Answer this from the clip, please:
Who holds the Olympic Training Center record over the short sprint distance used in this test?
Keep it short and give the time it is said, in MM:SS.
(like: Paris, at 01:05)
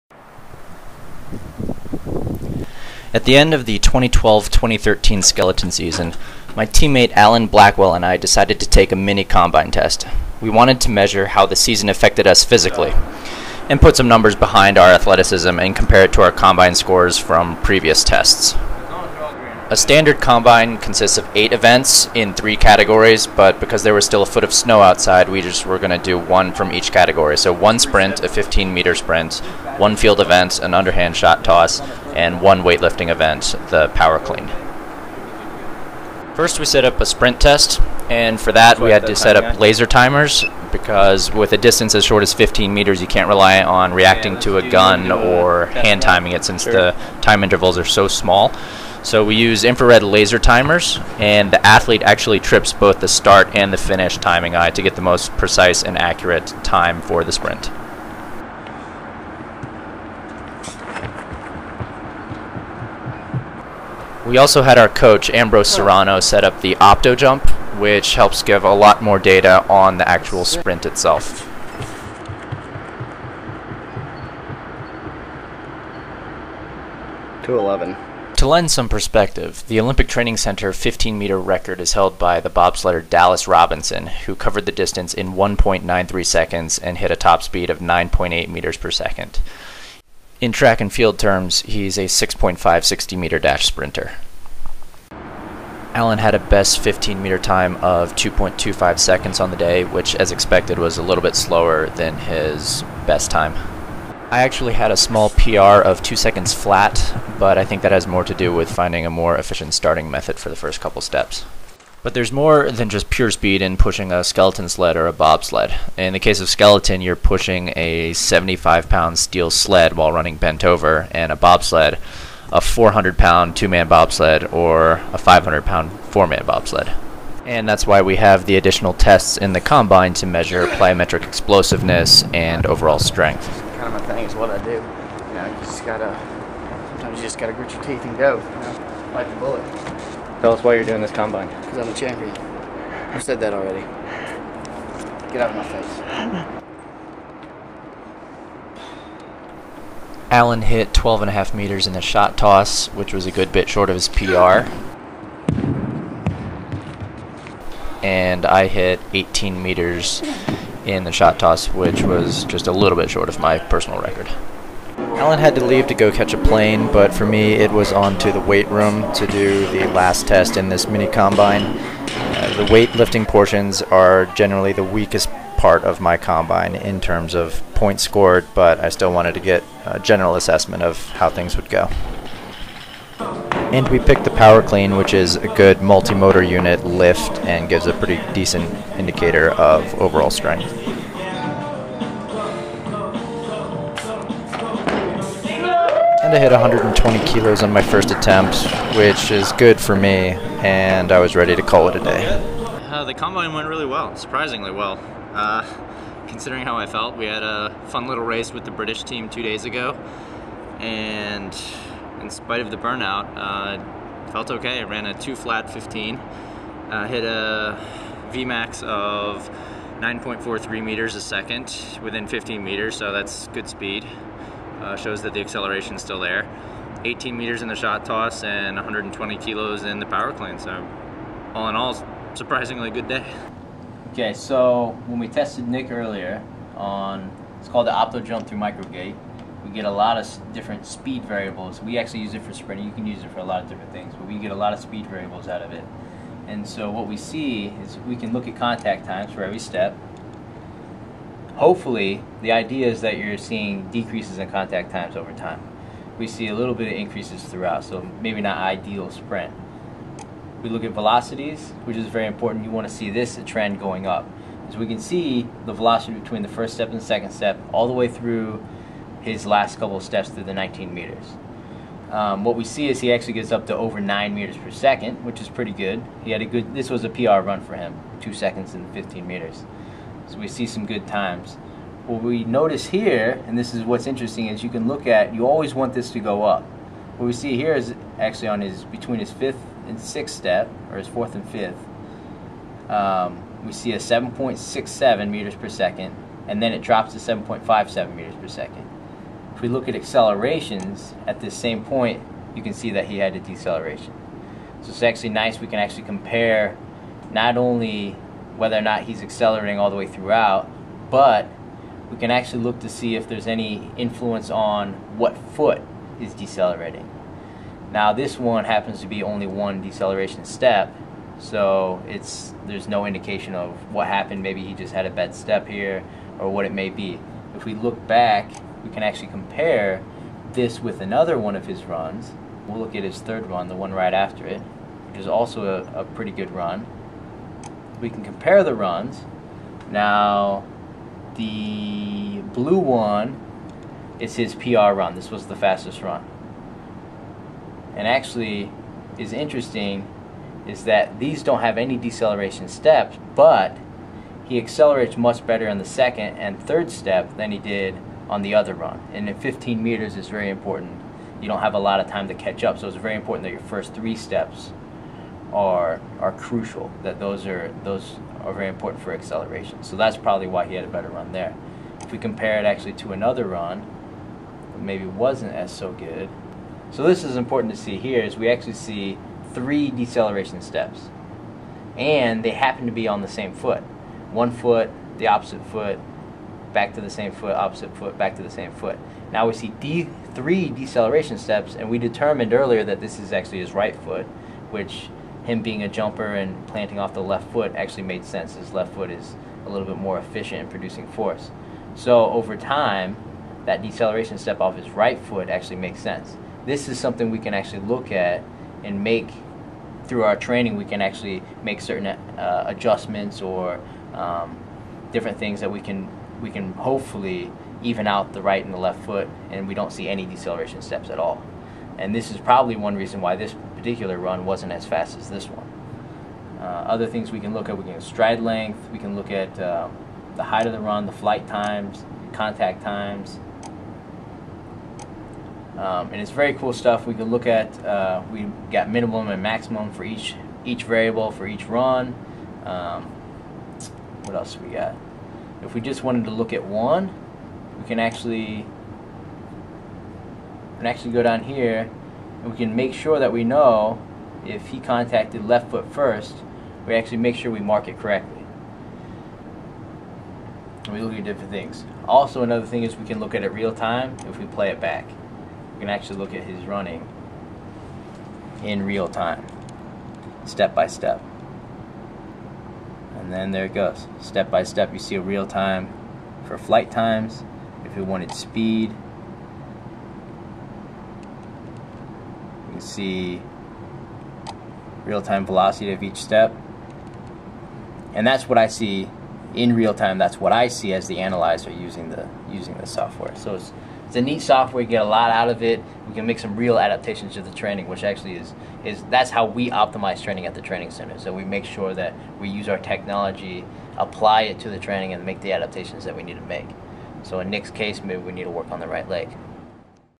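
Dallas Robinson, at 01:23.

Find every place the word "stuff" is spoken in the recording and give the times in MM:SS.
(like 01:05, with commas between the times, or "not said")
07:16.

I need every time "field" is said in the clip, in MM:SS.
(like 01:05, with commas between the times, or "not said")
00:29, 01:30.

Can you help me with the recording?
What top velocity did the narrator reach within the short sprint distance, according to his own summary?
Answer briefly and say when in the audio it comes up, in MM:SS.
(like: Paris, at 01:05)
9.43 meters per second, at 03:39.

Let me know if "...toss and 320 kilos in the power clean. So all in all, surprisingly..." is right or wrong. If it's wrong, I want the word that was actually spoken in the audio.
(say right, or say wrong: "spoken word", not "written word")
wrong: "120", not "320".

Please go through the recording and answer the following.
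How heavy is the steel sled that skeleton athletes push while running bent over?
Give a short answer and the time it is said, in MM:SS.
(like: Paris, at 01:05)
75 pounds, at 01:58.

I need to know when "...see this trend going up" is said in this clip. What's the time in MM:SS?
04:22.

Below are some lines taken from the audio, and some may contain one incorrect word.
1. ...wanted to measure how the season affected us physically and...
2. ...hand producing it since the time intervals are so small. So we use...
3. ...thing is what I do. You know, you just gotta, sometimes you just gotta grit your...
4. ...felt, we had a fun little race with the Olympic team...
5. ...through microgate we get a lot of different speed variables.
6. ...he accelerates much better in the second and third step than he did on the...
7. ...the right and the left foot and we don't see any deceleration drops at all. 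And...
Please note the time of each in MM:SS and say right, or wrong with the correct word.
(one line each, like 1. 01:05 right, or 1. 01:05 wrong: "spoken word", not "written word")
1. 00:10 right
2. 00:45 wrong: "timing", not "producing"
3. 02:14 right
4. 03:26 wrong: "British", not "Olympic"
5. 03:58 right
6. 05:54 right
7. 06:58 wrong: "steps", not "drops".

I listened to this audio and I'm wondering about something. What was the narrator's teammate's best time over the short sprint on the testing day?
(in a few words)
2.25 seconds.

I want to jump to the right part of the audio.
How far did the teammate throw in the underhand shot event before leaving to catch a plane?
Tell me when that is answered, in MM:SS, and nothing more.
02:30.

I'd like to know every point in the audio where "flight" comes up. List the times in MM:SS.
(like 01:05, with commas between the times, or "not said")
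07:11, 07:56.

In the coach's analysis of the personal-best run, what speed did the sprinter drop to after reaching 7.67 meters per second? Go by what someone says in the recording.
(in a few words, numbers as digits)
7.57 meters per second.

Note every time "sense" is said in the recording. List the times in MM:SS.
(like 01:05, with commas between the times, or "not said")
06:38, 06:45.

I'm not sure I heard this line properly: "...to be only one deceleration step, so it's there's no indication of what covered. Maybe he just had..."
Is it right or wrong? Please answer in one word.
wrong.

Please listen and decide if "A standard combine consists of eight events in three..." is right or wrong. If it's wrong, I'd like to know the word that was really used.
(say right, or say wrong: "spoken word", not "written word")
right.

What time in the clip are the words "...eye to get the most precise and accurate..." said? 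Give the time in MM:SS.
00:54.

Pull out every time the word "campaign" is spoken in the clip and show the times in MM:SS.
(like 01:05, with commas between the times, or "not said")
not said.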